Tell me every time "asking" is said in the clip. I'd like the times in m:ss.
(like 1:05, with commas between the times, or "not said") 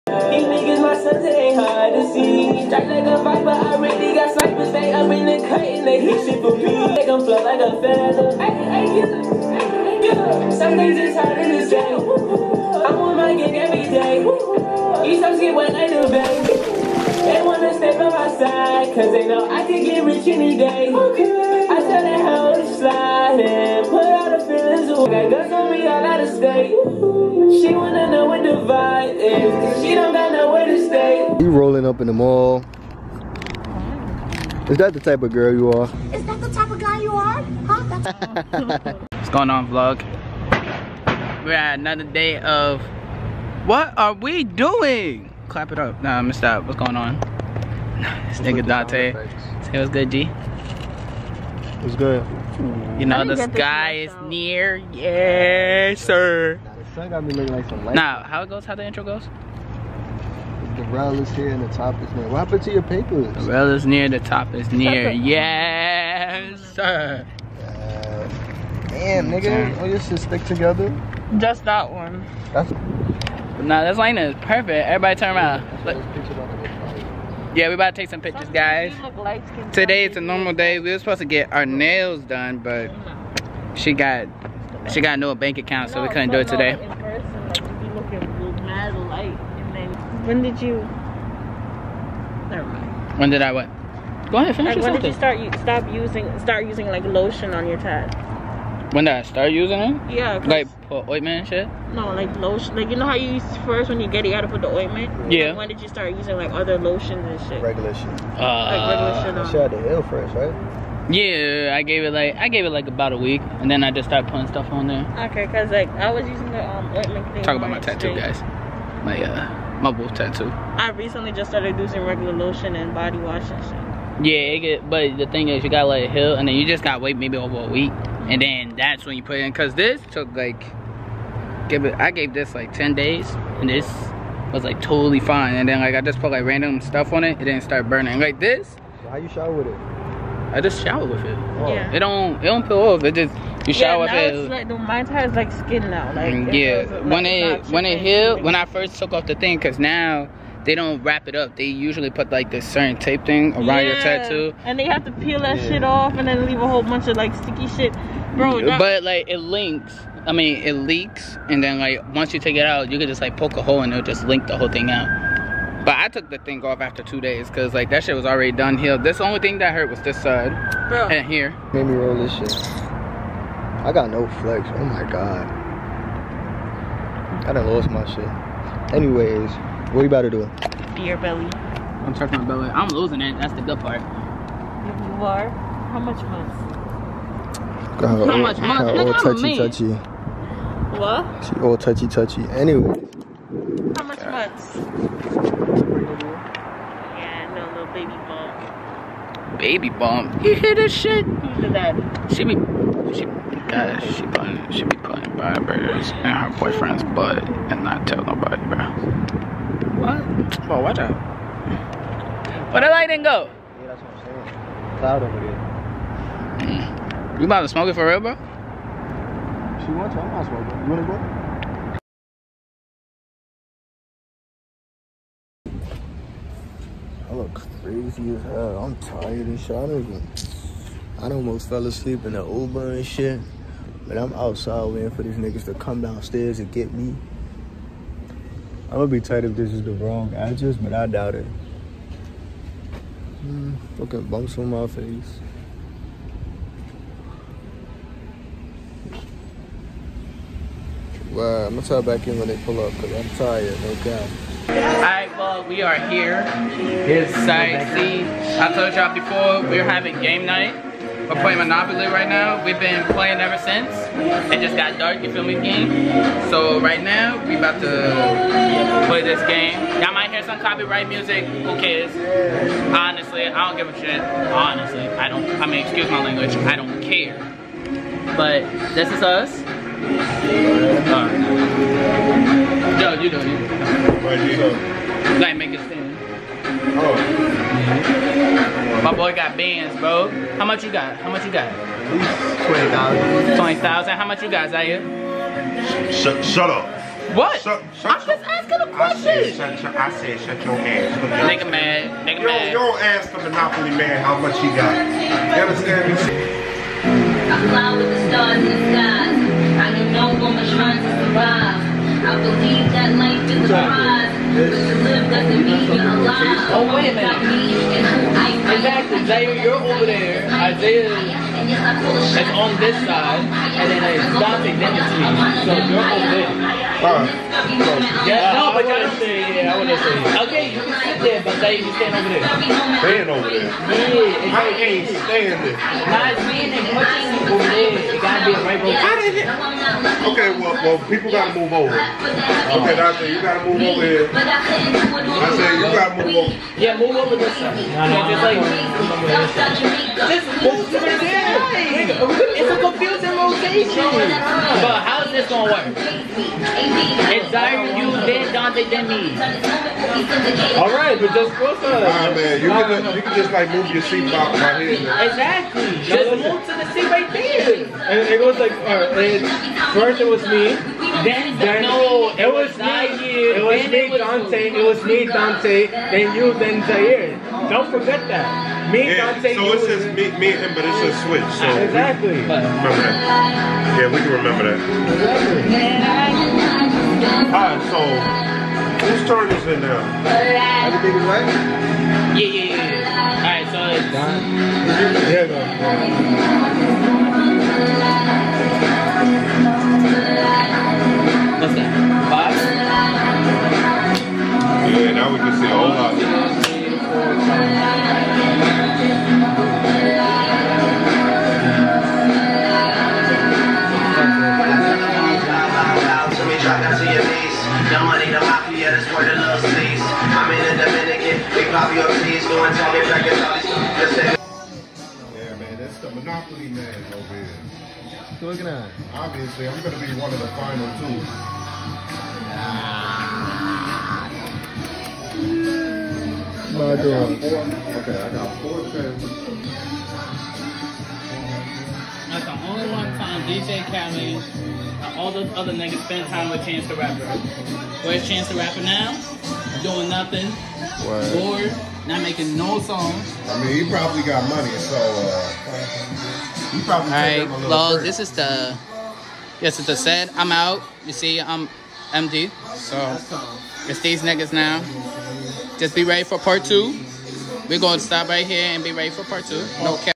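4:58.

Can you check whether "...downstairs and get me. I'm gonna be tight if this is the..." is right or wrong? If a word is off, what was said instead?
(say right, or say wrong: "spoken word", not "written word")
right.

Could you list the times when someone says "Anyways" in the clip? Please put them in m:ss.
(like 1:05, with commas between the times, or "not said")
2:58, 3:12.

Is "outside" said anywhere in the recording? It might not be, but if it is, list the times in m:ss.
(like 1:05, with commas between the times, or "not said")
3:54.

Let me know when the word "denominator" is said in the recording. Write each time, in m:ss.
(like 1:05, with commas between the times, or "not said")
not said.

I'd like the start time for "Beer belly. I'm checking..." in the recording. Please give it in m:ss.
3:00.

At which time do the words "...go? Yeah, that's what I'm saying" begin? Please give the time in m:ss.
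3:33.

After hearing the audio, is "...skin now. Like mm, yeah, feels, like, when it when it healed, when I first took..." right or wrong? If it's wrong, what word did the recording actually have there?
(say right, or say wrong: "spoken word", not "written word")
right.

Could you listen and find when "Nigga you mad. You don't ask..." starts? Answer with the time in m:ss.
5:02.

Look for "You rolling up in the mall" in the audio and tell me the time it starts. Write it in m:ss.
0:31.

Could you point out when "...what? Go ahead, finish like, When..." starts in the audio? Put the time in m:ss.
1:33.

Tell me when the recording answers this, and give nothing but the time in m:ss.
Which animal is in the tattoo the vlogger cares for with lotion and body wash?
1:59.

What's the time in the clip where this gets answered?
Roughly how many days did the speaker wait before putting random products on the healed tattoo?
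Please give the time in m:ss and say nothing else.
2:12.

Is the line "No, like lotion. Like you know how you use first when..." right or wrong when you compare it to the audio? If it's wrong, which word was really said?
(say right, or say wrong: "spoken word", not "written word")
right.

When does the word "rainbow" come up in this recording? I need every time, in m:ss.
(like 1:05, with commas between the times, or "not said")
5:38.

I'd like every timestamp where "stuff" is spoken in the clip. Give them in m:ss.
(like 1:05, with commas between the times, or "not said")
1:54, 2:16.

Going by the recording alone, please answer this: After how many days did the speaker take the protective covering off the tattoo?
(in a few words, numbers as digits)
2.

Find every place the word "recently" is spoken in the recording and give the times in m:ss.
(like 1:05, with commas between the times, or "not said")
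2:00.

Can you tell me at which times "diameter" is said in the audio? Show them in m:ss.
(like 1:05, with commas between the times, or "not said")
not said.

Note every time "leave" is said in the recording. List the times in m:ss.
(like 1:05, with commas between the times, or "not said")
2:36.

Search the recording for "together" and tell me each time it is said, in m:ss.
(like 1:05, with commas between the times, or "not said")
1:10.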